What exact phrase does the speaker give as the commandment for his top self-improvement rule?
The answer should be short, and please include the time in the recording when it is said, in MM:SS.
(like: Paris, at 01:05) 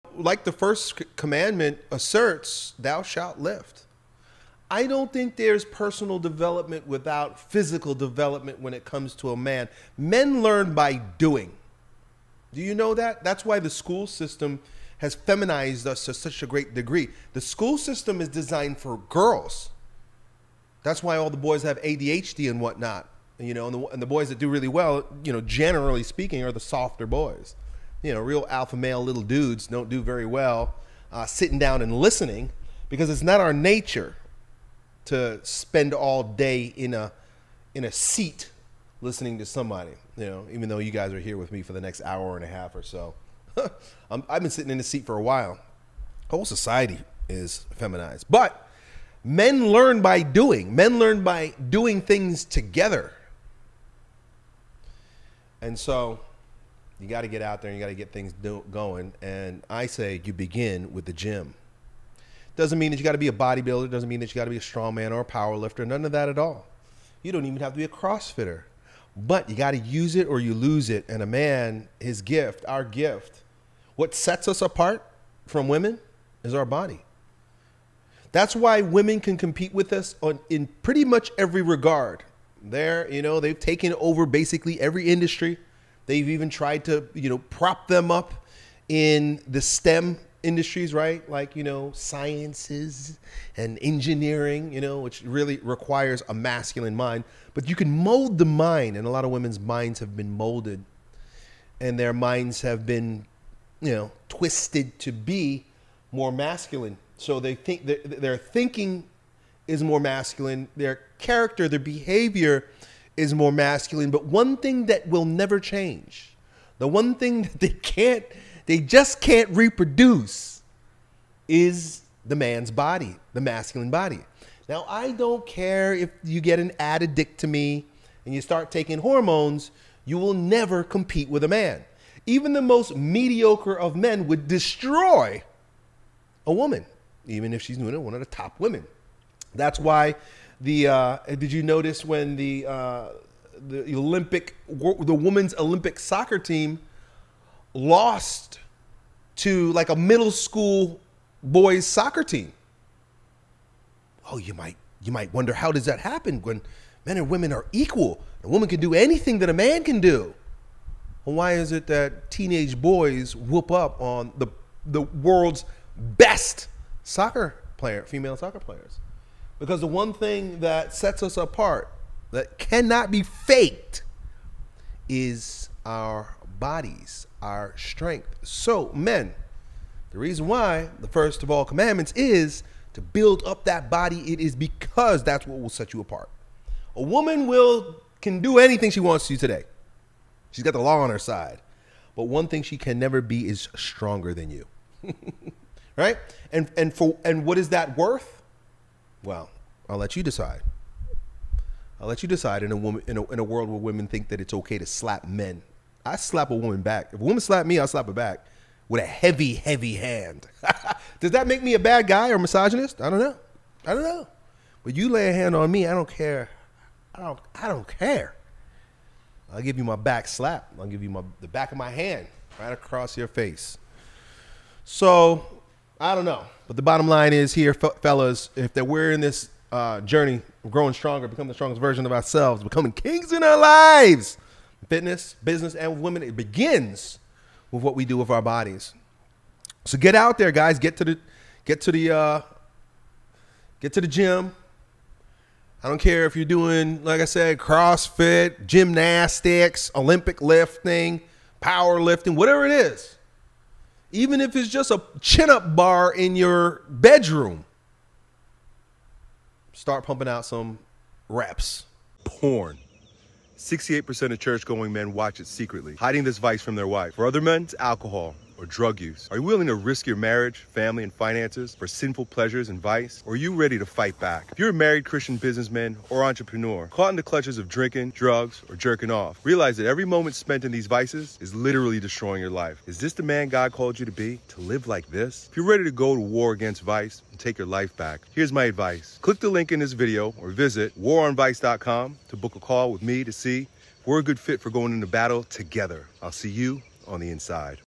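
Thou shalt lift, at 00:02.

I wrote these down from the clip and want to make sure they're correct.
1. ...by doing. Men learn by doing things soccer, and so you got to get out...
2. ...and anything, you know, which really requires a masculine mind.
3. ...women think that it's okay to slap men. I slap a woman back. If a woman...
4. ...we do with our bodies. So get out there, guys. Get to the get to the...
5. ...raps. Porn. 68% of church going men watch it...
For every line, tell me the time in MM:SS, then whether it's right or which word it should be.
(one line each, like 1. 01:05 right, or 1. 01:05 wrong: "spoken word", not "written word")
1. 00:50 wrong: "together", not "soccer"
2. 01:33 wrong: "engineering", not "anything"
3. 03:23 right
4. 03:57 right
5. 04:21 right.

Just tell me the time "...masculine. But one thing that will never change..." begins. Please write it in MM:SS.
01:53.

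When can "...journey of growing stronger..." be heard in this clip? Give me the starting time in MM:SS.
03:50.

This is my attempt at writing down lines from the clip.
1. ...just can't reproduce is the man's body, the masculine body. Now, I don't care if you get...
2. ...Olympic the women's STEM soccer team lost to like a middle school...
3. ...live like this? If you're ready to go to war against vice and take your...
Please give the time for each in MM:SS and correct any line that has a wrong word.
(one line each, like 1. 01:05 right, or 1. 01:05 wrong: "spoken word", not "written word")
1. 01:58 right
2. 02:23 wrong: "Olympic", not "STEM"
3. 04:44 right.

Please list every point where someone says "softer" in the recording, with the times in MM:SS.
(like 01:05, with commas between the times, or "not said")
00:26.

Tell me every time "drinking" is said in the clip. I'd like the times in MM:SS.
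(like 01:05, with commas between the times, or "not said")
04:37.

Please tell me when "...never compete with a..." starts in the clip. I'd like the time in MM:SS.
02:10.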